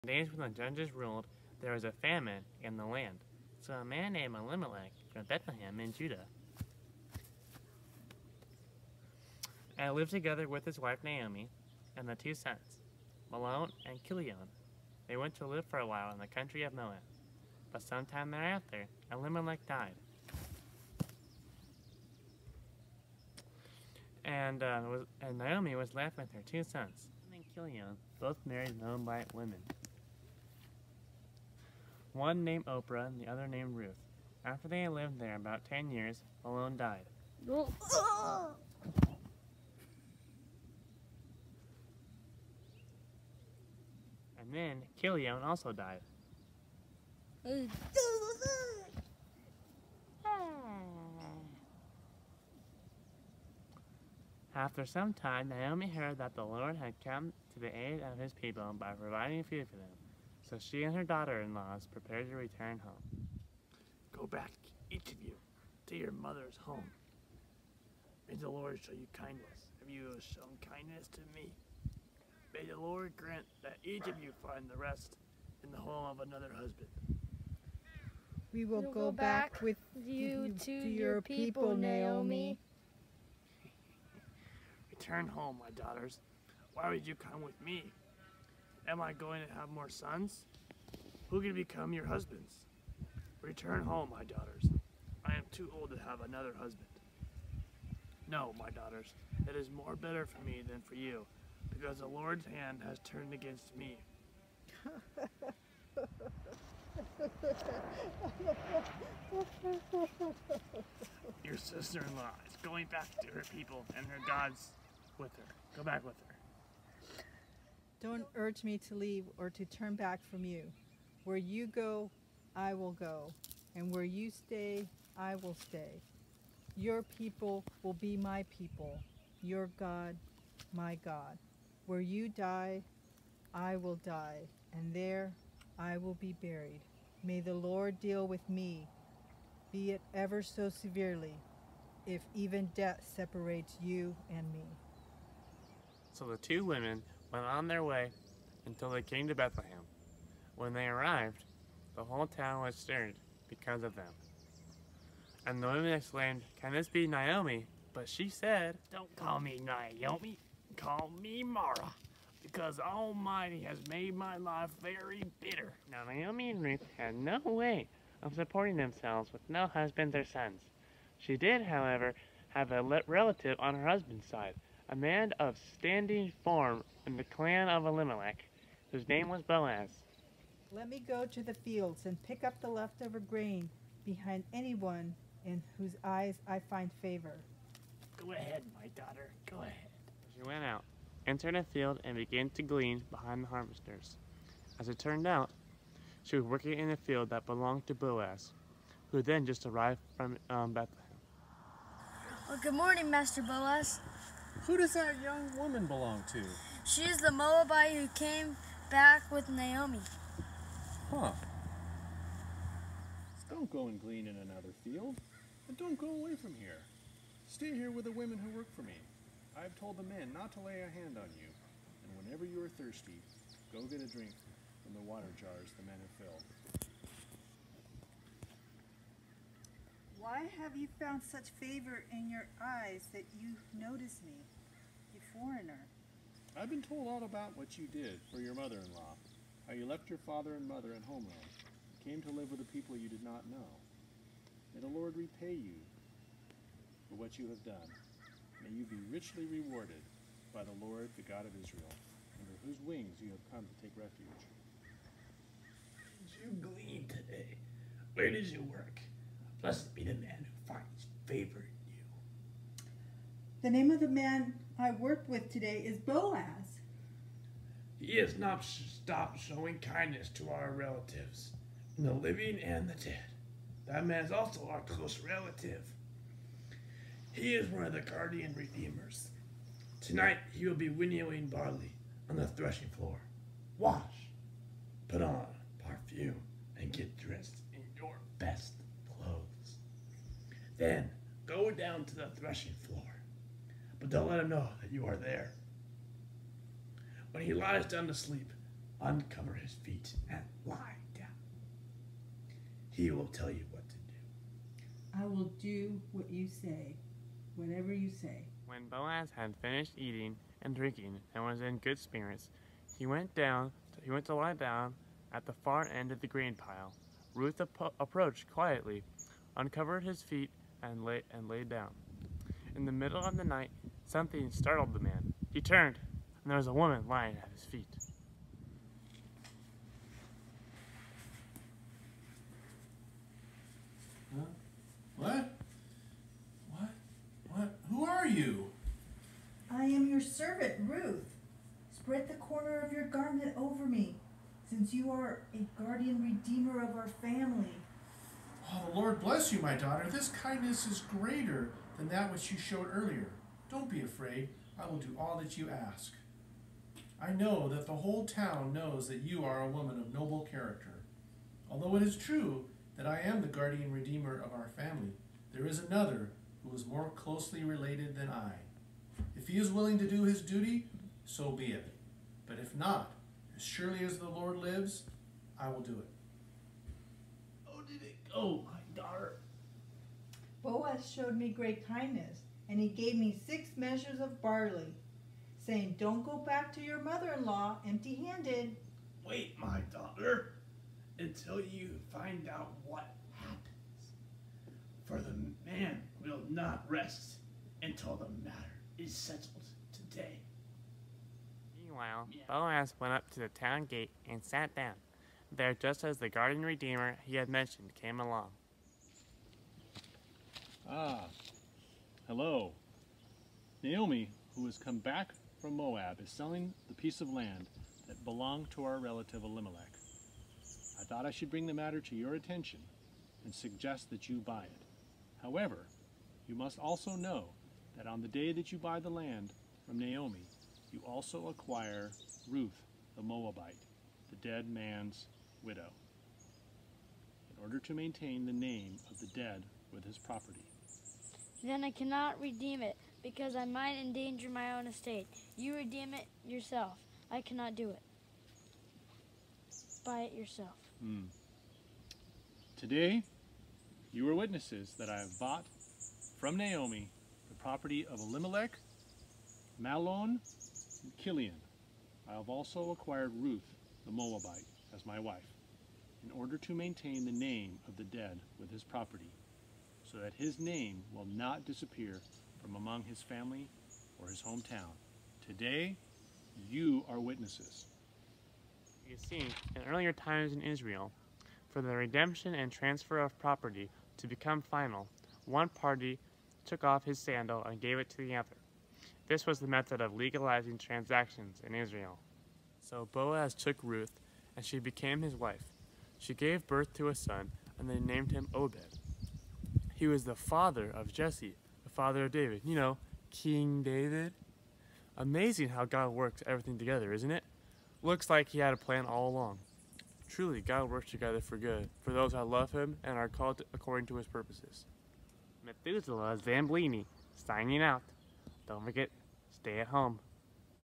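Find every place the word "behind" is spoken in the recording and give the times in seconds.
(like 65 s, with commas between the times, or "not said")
184 s, 193 s.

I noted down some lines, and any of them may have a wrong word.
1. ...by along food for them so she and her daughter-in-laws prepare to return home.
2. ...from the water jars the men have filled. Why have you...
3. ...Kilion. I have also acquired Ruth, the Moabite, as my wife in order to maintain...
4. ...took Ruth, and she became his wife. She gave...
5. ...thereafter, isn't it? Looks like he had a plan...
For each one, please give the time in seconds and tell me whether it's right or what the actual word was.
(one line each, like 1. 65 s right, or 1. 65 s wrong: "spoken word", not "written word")
1. 58 s wrong: "providing", not "along"
2. 224 s right
3. 461 s right
4. 493 s right
5. 506 s wrong: "together", not "thereafter".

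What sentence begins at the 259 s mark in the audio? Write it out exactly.
Blessed be the man who finds favor in you.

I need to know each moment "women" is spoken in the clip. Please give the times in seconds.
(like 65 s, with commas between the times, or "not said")
29 s, 146 s, 155 s, 218 s.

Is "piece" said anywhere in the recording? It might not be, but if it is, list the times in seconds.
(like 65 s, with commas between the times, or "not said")
416 s.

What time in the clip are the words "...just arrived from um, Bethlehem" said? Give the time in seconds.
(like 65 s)
199 s.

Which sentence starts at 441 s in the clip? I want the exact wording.
Then I cannot redeem it, because I might endanger my own estate.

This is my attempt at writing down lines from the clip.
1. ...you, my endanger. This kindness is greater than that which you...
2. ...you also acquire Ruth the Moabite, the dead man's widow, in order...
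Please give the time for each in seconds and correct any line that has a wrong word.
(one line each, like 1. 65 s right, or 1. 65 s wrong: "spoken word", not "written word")
1. 349 s wrong: "daughter", not "endanger"
2. 430 s right.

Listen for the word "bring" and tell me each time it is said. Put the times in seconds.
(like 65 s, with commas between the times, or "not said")
421 s.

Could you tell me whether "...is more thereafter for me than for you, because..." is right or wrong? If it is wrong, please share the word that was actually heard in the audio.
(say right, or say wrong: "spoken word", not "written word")
wrong: "better", not "thereafter".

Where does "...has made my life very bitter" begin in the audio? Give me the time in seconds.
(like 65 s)
163 s.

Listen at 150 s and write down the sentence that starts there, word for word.
When they arrived, the whole town was stirred because of them.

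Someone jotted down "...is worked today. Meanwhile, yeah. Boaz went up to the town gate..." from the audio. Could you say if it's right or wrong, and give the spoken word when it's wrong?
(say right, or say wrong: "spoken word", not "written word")
wrong: "settled", not "worked".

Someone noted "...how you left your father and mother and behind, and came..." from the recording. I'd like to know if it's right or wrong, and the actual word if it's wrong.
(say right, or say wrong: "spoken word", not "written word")
wrong: "homeland", not "behind".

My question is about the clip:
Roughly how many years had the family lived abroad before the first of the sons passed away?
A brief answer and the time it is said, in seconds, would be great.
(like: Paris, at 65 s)
10, at 35 s.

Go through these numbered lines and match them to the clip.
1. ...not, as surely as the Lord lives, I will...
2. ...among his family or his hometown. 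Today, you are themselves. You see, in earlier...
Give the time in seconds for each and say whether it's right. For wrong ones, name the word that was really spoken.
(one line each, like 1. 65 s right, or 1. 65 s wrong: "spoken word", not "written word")
1. 372 s right
2. 472 s wrong: "witnesses", not "themselves".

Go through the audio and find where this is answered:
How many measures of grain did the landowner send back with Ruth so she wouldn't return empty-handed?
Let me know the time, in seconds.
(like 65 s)
383 s.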